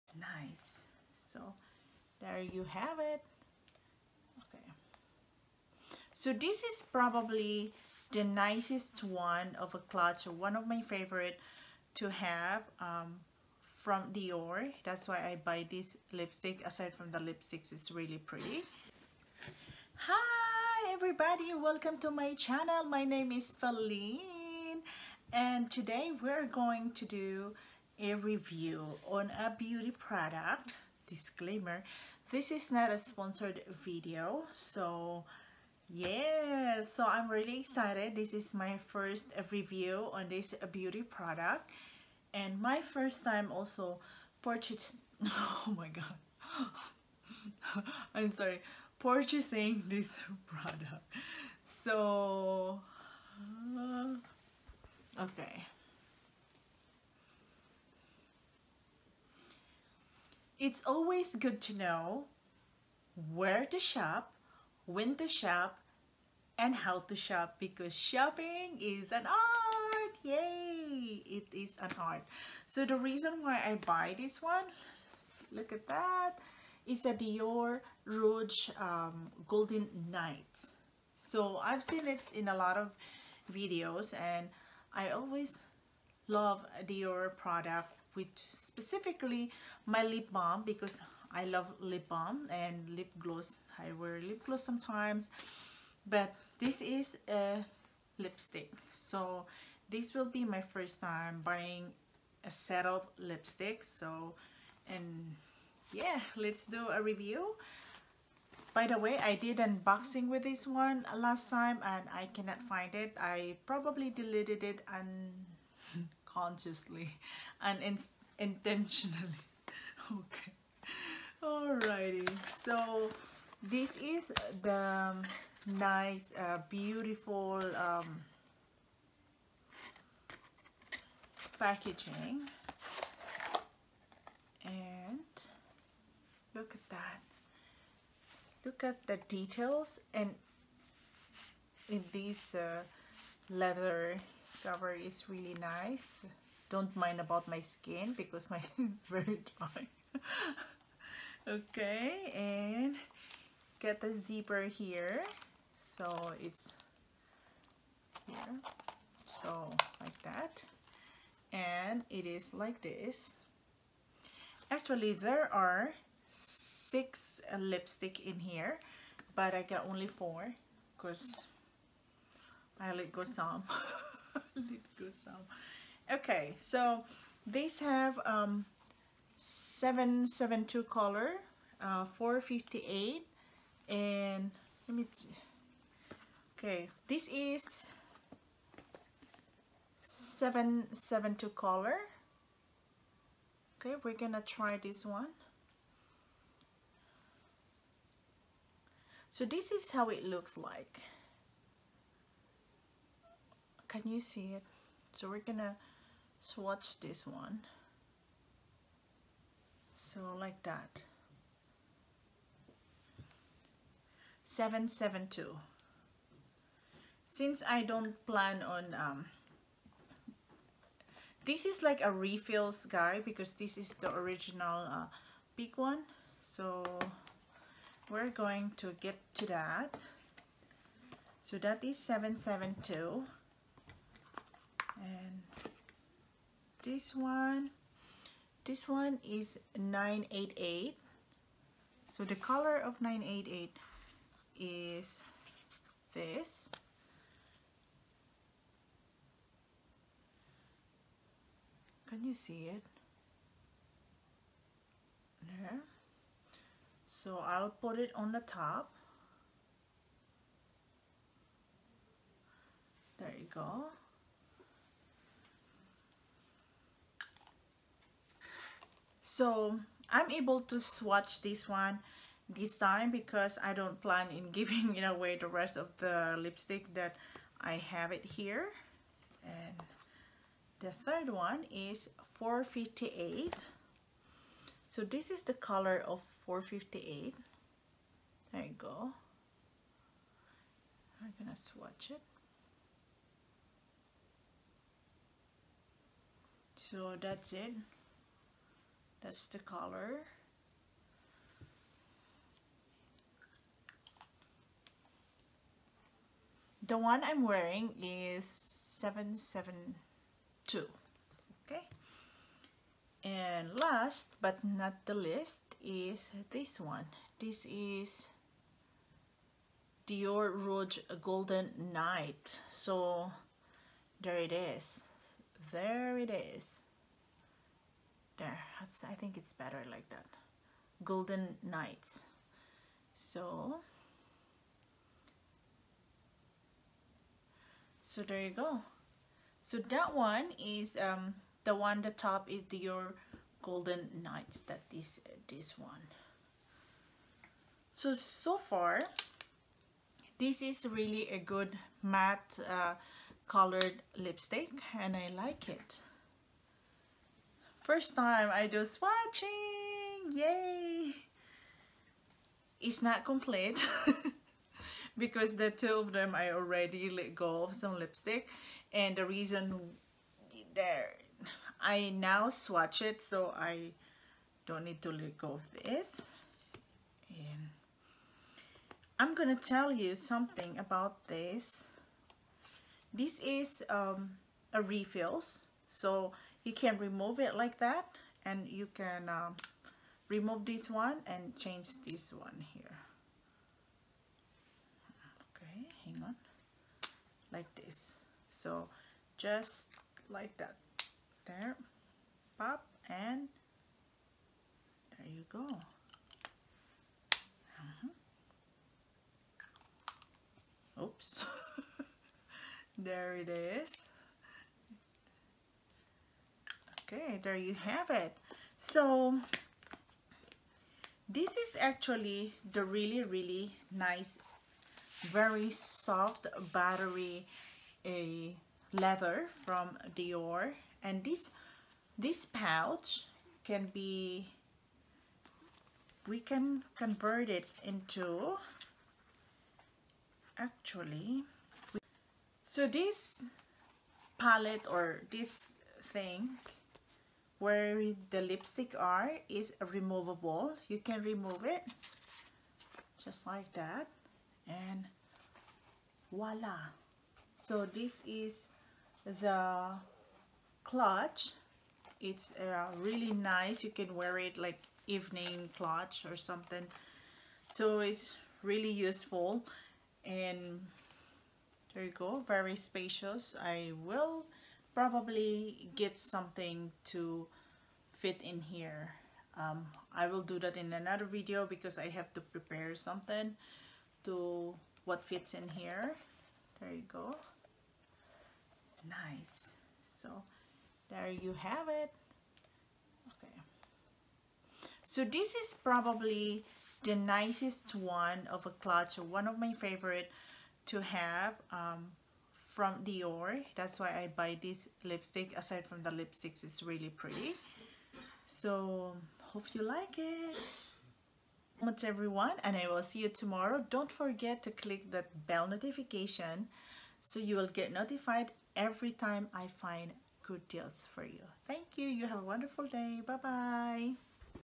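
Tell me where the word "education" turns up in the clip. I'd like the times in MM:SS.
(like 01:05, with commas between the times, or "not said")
not said.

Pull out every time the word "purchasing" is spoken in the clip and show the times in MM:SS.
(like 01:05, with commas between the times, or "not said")
00:44, 00:48.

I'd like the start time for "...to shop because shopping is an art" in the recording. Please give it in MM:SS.
01:07.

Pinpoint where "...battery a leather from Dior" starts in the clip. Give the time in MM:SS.
07:06.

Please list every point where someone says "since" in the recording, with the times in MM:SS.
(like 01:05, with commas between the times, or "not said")
03:37.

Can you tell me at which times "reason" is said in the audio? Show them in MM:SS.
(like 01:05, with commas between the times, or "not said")
01:13, 06:09.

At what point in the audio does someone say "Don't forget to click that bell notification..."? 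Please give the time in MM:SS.
08:33.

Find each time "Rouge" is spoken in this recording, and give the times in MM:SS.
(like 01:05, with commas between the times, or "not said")
01:18, 05:20.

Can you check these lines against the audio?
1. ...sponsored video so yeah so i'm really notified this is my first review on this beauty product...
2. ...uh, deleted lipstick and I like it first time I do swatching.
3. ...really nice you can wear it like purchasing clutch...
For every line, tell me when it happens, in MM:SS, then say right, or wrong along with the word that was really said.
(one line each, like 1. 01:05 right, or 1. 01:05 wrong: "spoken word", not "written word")
1. 00:32 wrong: "excited", not "notified"
2. 05:52 wrong: "colored", not "deleted"
3. 07:42 wrong: "evening", not "purchasing".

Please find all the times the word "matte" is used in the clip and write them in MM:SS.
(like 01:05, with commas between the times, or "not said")
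05:52.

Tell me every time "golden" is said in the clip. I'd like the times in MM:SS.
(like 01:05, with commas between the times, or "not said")
01:19, 05:21, 05:31, 05:43.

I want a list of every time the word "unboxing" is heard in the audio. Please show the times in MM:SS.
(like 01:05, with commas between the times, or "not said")
01:49.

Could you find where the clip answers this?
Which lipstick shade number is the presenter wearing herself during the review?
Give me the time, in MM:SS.
05:06.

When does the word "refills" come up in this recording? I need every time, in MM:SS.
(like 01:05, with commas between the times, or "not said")
03:42, 06:24.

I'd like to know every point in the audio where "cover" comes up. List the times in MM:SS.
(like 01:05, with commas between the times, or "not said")
02:24.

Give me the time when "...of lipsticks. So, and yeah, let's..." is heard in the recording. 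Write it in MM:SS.
01:42.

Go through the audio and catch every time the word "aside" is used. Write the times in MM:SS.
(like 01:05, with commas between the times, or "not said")
00:16, 08:25.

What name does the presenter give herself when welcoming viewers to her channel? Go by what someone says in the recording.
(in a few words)
Feline.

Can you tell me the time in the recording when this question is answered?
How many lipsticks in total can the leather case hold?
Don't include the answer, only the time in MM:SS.
02:46.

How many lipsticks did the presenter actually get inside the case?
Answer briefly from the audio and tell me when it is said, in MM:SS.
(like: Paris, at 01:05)
4, at 02:50.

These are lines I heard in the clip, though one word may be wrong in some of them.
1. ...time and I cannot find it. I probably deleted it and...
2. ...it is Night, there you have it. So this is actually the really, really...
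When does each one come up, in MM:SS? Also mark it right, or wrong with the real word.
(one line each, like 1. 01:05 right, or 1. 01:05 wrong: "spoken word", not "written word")
1. 01:51 right
2. 06:53 wrong: "Okay", not "Night".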